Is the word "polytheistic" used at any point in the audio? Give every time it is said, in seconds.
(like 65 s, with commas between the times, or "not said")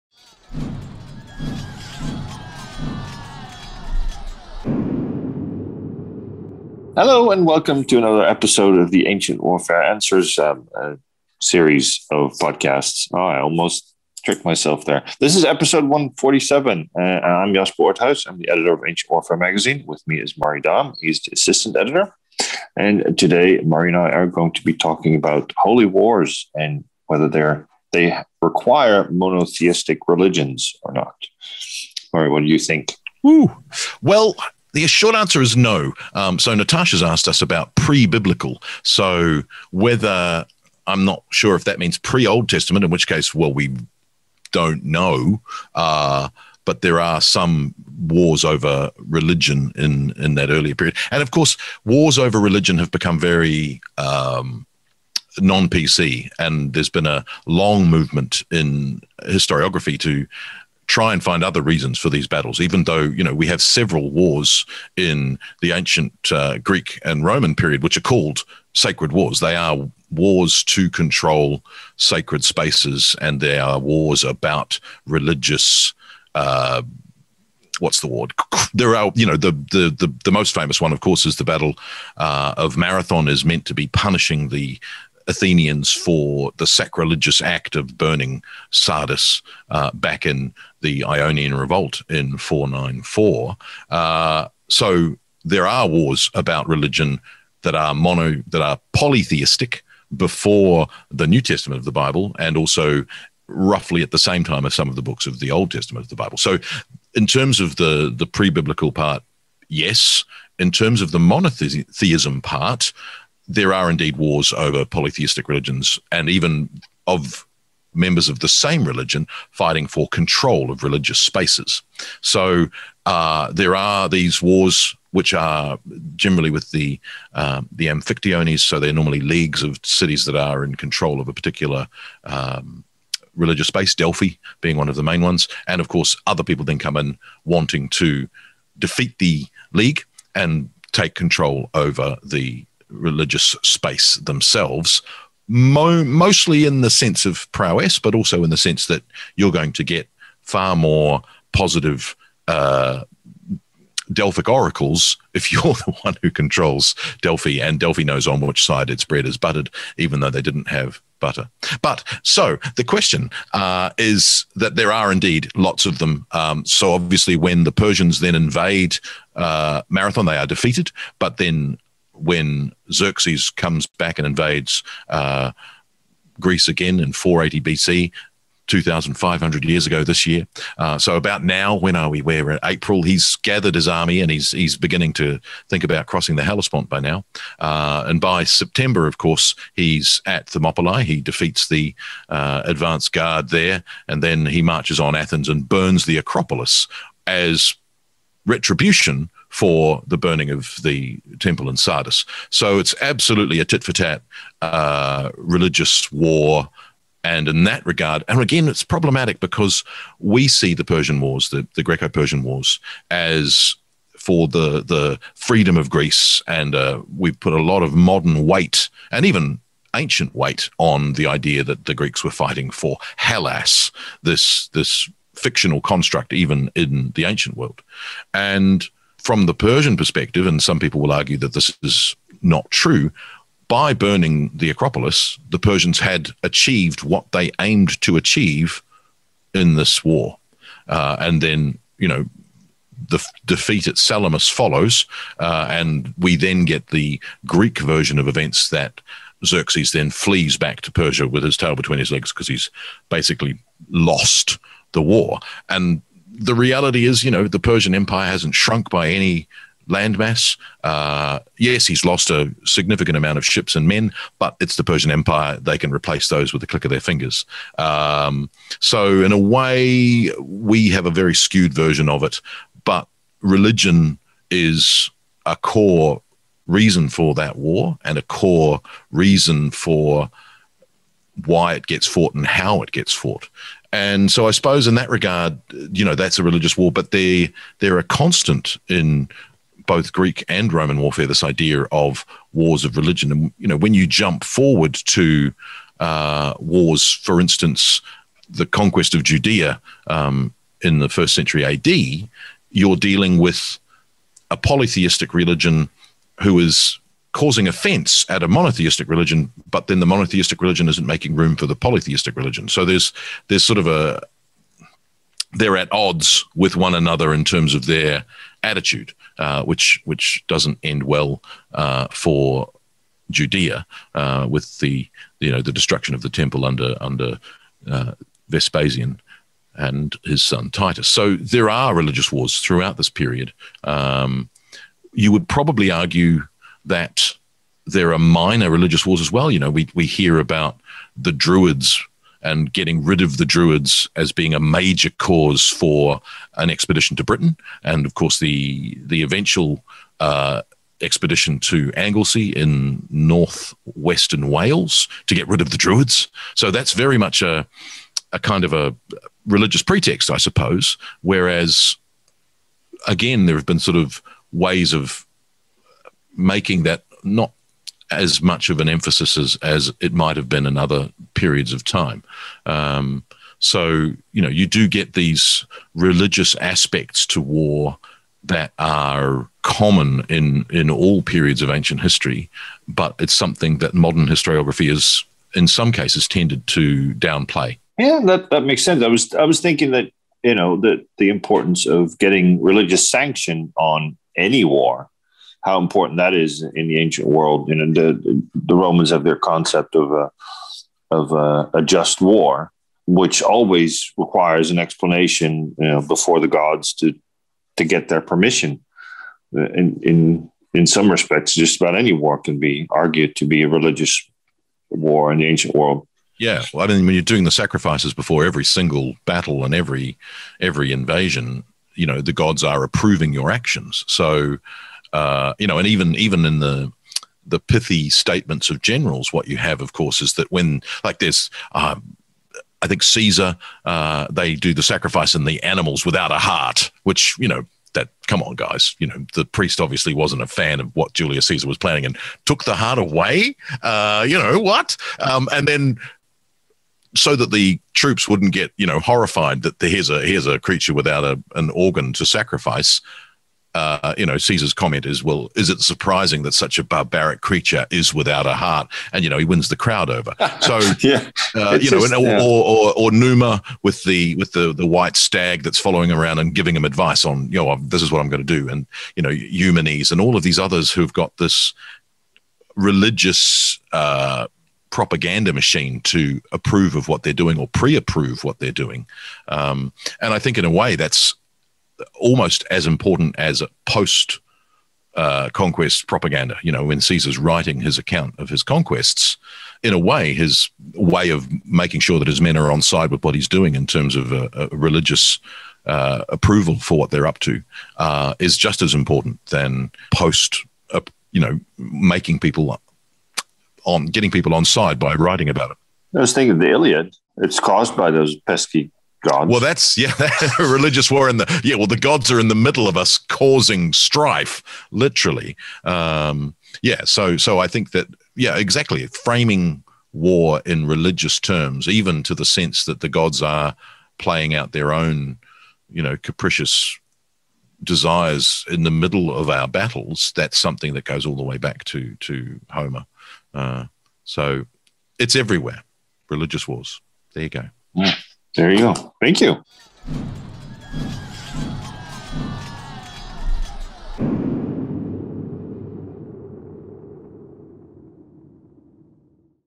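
98 s, 114 s, 304 s, 311 s.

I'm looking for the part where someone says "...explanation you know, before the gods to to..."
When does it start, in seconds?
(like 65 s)
404 s.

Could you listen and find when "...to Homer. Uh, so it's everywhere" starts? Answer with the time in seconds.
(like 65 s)
532 s.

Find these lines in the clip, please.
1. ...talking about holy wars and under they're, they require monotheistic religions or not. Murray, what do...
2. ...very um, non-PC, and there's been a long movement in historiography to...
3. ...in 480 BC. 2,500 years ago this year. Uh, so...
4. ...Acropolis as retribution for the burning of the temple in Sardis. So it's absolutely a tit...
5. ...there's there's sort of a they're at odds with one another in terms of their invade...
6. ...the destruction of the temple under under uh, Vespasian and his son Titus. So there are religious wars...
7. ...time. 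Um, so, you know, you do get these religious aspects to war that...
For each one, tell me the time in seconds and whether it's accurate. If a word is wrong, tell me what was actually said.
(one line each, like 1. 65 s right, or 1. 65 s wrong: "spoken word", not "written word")
1. 24 s wrong: "whether", not "under"
2. 53 s right
3. 176 s right
4. 196 s right
5. 312 s wrong: "attitude", not "invade"
6. 325 s right
7. 371 s right.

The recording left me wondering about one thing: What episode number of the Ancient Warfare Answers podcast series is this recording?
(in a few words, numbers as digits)
147.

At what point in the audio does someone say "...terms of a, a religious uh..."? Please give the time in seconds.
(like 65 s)
493 s.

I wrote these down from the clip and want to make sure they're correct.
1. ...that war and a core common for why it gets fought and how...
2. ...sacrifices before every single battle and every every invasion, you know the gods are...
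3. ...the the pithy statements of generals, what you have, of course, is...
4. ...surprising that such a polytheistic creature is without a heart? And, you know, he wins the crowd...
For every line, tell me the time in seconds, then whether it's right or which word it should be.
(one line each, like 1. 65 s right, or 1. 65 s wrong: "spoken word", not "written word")
1. 277 s wrong: "reason", not "common"
2. 417 s right
3. 426 s right
4. 455 s wrong: "barbaric", not "polytheistic".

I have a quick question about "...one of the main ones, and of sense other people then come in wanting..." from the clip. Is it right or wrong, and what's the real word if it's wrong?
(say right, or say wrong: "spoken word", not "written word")
wrong: "course", not "sense".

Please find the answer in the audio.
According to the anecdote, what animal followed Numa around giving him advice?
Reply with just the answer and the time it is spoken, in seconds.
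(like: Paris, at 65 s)
white stag, at 464 s.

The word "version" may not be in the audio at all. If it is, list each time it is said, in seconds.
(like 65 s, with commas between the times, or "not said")
247 s, 271 s.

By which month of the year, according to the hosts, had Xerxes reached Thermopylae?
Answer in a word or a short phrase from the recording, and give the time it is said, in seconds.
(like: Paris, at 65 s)
September, at 188 s.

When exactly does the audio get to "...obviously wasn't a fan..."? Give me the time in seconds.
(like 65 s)
439 s.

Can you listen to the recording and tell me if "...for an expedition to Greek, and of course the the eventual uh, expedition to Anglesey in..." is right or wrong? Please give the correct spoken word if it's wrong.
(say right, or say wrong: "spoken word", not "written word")
wrong: "Britain", not "Greek".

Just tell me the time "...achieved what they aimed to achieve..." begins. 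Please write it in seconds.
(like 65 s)
236 s.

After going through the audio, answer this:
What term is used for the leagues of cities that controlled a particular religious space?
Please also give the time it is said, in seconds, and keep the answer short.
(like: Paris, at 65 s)
amphictyones, at 127 s.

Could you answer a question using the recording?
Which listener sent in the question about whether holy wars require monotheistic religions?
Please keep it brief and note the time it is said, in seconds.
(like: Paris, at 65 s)
Natasha, at 36 s.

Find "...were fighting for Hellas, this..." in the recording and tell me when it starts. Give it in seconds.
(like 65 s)
222 s.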